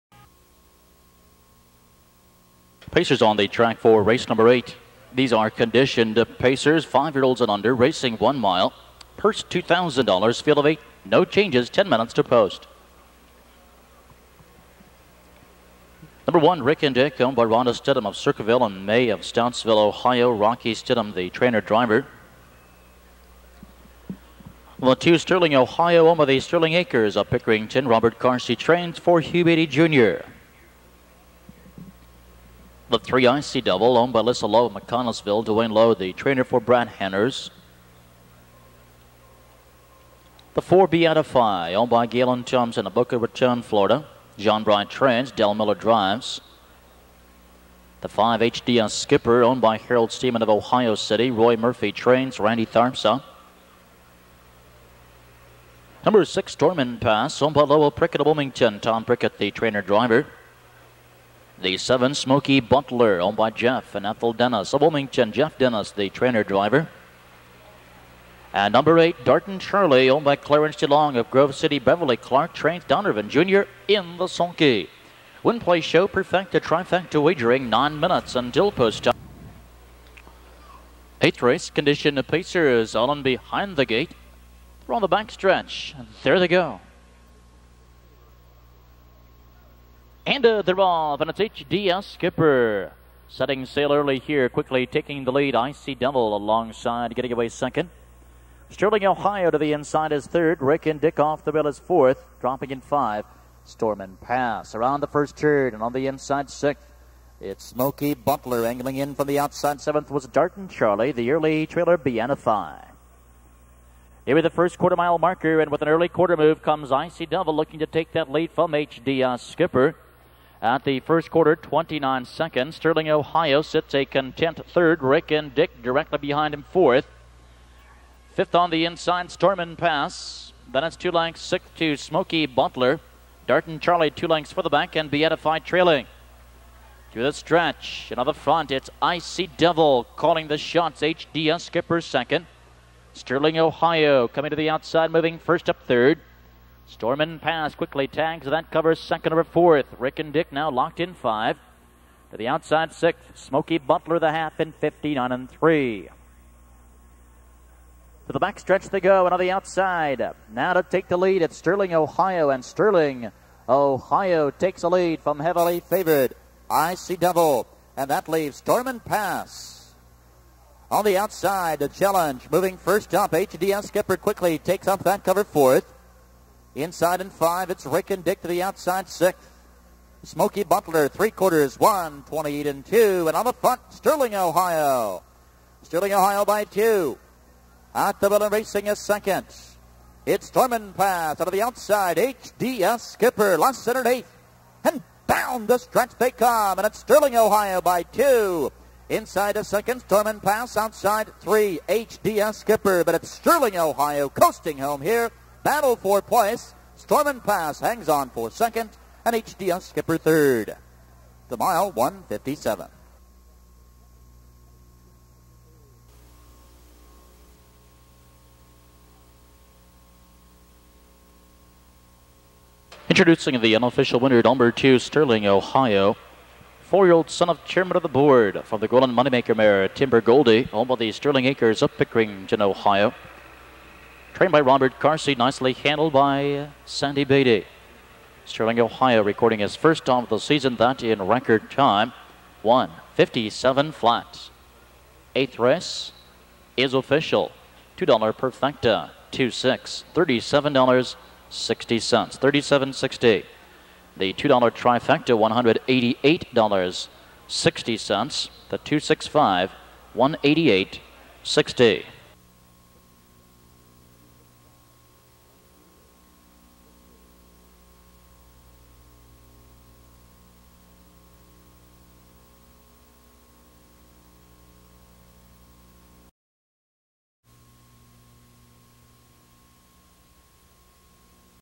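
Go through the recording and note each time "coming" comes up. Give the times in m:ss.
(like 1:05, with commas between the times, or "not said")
2:24.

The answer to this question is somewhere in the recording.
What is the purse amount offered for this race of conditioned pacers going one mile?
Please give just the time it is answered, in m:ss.
0:09.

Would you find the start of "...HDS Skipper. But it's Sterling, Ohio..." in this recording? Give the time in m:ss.
3:21.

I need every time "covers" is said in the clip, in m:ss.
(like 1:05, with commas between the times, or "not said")
2:28, 2:55.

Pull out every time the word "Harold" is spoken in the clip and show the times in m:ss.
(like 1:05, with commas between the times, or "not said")
0:49.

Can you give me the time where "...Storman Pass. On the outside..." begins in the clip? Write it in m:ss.
2:48.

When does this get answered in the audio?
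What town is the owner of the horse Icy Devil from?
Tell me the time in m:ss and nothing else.
0:34.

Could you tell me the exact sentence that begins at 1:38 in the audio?
Sterling, Ohio to the inside is third.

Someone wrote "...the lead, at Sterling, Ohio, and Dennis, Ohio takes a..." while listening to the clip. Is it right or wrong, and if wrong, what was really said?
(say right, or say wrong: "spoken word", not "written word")
wrong: "Sterling", not "Dennis".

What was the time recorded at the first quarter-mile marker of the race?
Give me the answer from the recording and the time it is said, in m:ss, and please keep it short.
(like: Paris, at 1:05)
29 seconds, at 2:01.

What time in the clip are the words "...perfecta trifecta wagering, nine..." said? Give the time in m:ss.
1:16.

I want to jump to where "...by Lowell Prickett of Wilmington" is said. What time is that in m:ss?
0:57.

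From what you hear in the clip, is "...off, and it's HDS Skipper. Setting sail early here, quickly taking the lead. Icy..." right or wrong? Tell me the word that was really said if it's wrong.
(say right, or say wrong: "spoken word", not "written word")
right.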